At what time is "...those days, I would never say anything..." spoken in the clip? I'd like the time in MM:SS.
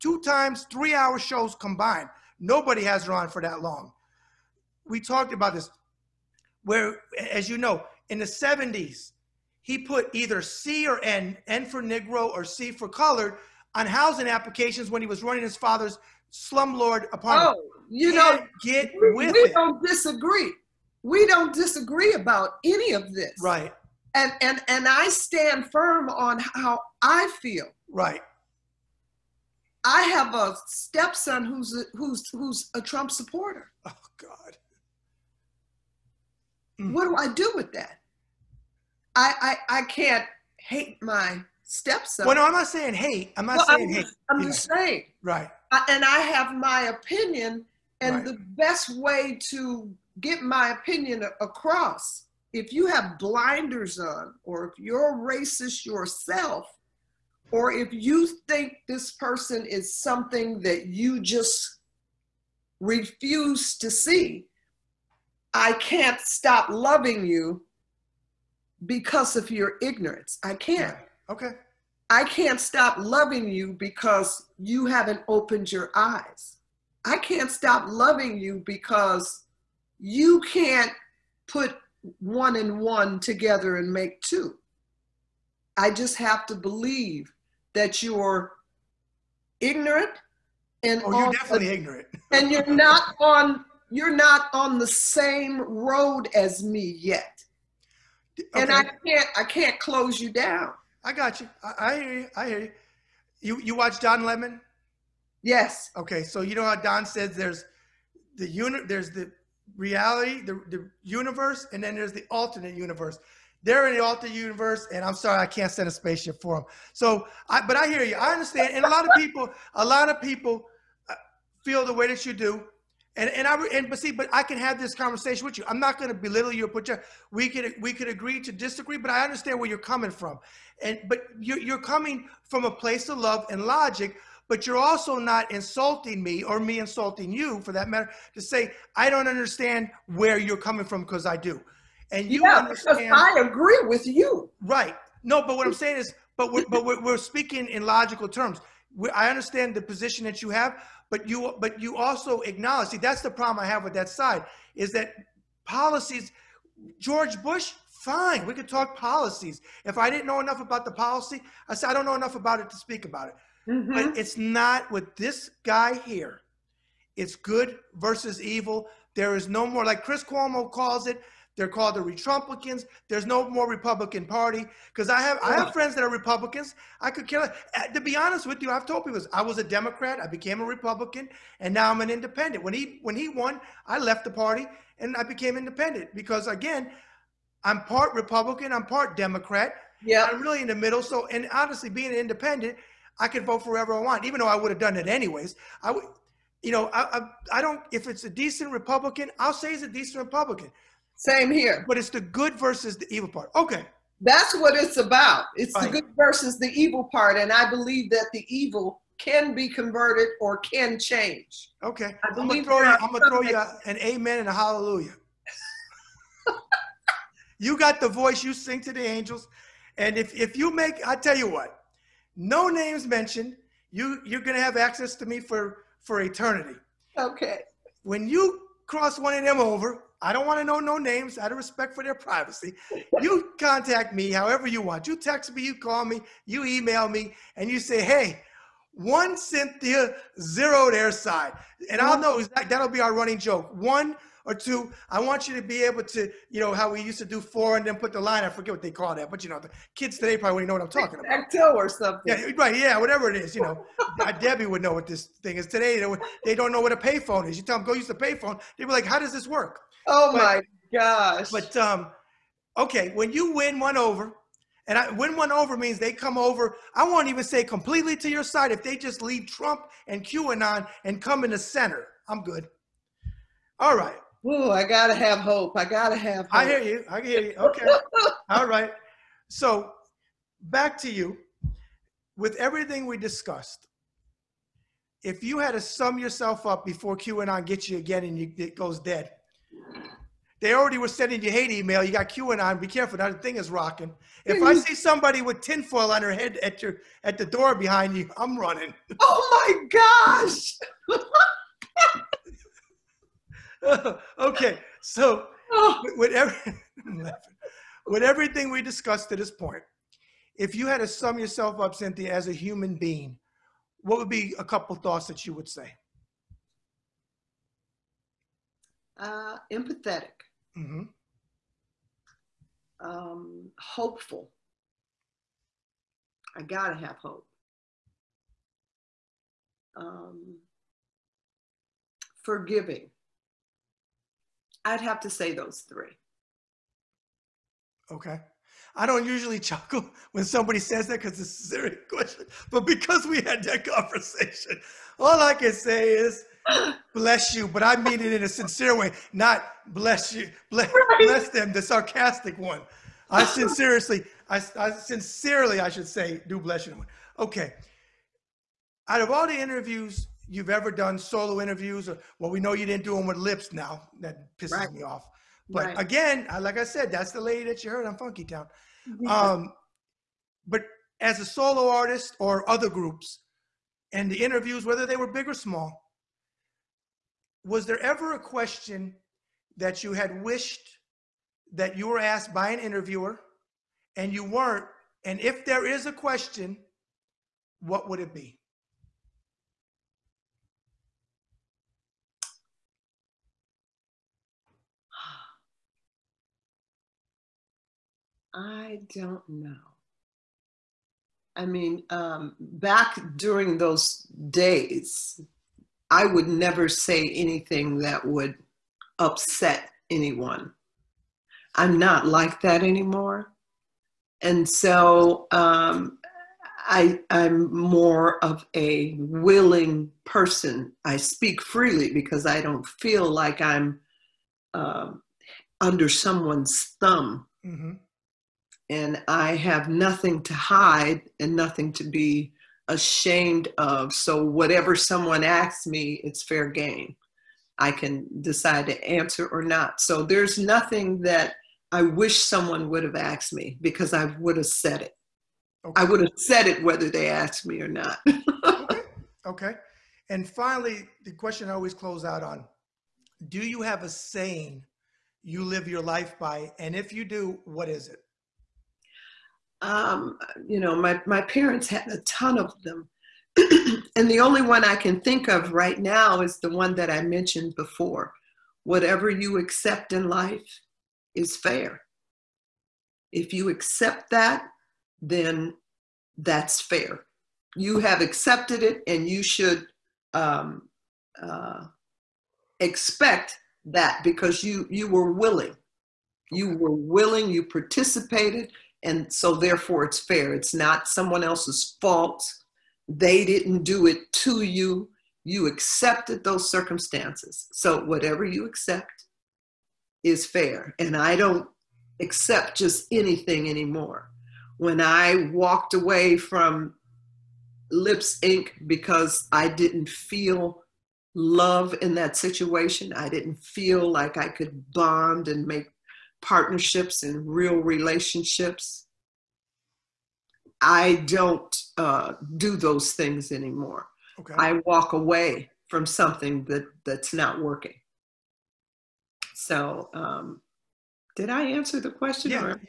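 06:43.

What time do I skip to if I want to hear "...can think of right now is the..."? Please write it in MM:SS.
07:44.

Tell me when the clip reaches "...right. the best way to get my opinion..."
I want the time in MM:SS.
00:48.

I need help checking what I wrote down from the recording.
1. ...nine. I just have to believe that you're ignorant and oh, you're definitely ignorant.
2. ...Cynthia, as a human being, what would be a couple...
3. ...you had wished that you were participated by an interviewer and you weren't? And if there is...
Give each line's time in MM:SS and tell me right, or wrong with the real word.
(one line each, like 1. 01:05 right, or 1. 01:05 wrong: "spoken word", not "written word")
1. 01:24 wrong: "two", not "nine"
2. 05:11 right
3. 06:20 wrong: "asked", not "participated".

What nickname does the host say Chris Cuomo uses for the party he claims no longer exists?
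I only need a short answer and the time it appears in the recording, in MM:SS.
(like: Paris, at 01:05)
Retrumplicans, at 02:51.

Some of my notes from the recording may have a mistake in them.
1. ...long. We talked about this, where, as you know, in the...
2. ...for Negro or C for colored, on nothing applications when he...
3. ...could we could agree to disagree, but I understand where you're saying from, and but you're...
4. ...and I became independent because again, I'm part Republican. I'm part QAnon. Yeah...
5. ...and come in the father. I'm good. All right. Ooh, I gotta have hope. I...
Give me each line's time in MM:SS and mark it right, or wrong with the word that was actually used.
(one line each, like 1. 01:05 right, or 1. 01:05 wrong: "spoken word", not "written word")
1. 00:03 right
2. 00:11 wrong: "housing", not "nothing"
3. 02:07 wrong: "coming", not "saying"
4. 03:04 wrong: "Democrat", not "QAnon"
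5. 04:31 wrong: "center", not "father".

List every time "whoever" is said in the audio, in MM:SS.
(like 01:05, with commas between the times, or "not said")
03:13.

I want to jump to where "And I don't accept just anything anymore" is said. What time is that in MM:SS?
08:20.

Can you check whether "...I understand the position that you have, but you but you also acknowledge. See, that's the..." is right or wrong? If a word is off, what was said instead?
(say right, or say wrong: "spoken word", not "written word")
right.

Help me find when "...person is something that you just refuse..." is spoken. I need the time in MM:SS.
00:59.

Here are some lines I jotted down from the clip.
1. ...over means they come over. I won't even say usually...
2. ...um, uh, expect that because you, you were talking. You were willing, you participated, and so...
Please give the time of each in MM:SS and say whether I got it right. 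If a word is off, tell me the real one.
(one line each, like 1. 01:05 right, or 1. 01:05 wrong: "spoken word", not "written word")
1. 04:25 wrong: "completely", not "usually"
2. 08:00 wrong: "willing", not "talking".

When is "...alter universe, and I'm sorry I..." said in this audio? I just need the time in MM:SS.
01:54.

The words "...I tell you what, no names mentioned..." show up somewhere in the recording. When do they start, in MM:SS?
03:41.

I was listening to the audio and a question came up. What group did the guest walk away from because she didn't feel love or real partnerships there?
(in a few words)
Lipps Inc.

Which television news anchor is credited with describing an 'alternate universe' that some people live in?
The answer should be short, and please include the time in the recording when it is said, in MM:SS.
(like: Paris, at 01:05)
Don Lemon, at 01:43.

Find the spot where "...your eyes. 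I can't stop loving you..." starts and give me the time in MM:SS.
01:15.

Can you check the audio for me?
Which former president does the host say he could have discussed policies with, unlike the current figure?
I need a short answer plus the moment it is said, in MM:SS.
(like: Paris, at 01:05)
George Bush, at 02:36.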